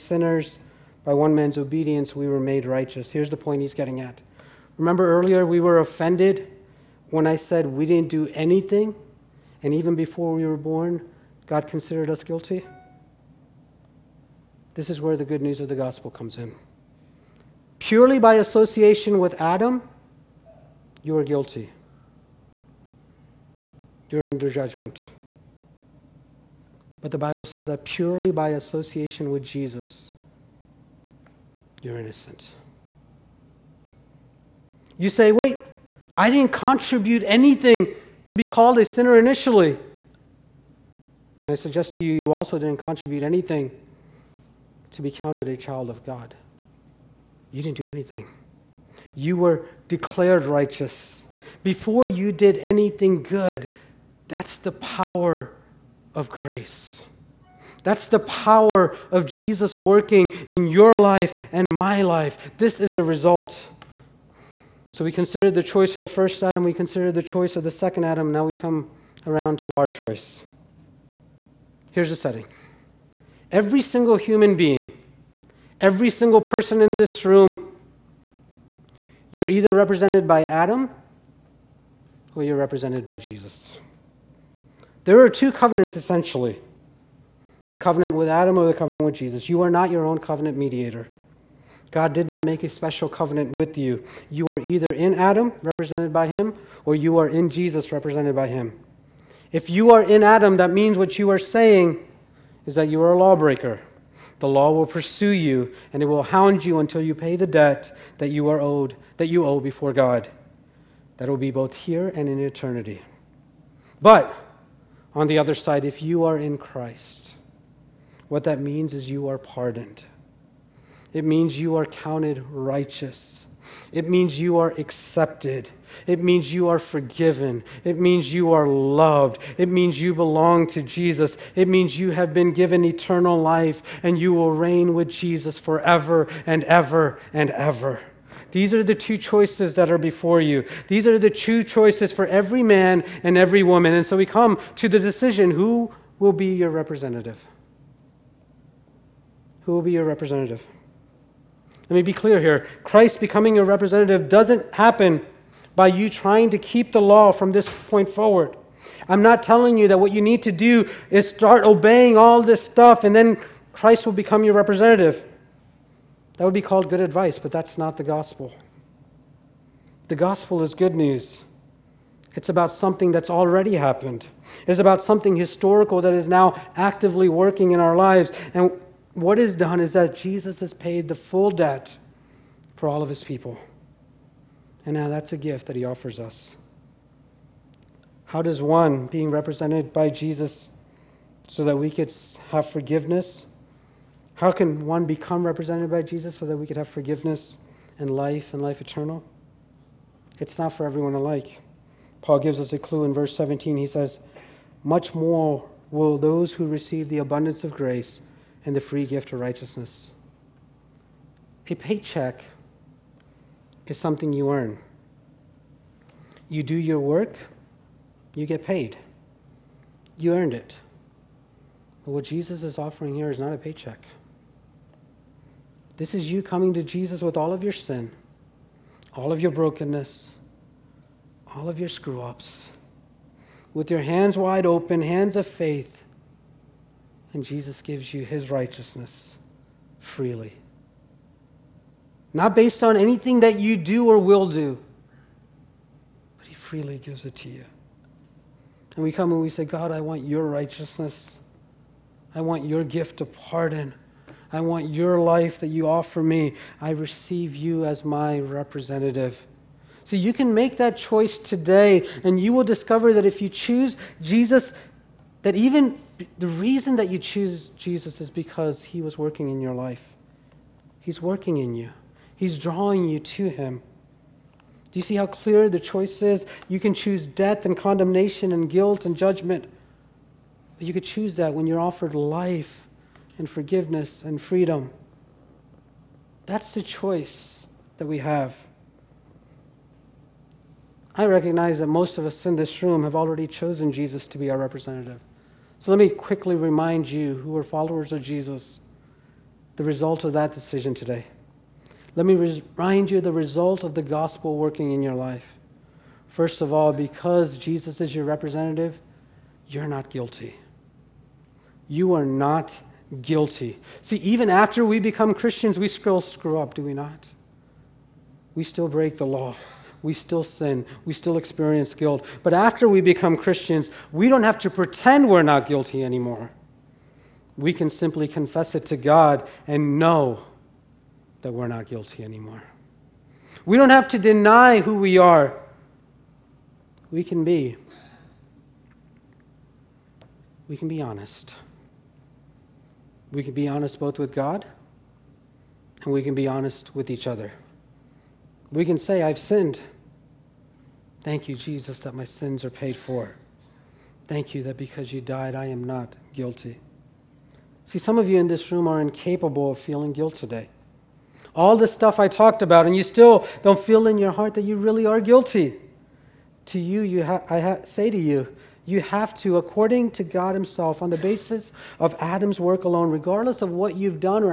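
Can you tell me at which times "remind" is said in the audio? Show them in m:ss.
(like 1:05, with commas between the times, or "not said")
4:56, 5:02.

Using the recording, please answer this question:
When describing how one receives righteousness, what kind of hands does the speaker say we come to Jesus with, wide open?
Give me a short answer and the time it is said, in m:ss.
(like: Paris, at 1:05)
Hands of faith, at 3:55.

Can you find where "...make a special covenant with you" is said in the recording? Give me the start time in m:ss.
1:32.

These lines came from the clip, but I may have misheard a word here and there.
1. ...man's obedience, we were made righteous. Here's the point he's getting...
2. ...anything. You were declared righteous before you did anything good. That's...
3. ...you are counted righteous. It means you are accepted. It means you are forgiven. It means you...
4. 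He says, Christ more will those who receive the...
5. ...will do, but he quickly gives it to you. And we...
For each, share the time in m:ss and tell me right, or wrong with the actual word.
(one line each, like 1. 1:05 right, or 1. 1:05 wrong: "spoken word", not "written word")
1. 0:01 right
2. 0:47 right
3. 2:01 right
4. 3:23 wrong: "Much", not "Christ"
5. 4:04 wrong: "freely", not "quickly".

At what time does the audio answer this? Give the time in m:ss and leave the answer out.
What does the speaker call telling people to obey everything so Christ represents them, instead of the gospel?
2:46.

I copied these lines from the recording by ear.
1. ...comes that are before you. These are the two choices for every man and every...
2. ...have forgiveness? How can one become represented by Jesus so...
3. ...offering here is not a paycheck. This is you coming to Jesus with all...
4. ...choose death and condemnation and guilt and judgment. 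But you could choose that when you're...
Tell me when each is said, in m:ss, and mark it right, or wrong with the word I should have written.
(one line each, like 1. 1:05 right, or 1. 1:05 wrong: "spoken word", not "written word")
1. 2:19 wrong: "choices", not "comes"
2. 3:12 right
3. 3:42 right
4. 4:36 right.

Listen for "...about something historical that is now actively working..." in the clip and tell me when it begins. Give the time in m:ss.
2:54.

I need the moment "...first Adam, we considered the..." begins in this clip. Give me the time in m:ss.
1:06.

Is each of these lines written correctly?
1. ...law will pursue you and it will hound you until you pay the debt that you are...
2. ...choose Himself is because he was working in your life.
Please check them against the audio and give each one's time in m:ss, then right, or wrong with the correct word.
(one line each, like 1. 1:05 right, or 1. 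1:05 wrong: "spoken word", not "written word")
1. 1:44 right
2. 4:27 wrong: "Jesus", not "Himself".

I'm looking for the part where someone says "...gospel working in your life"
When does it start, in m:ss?
5:04.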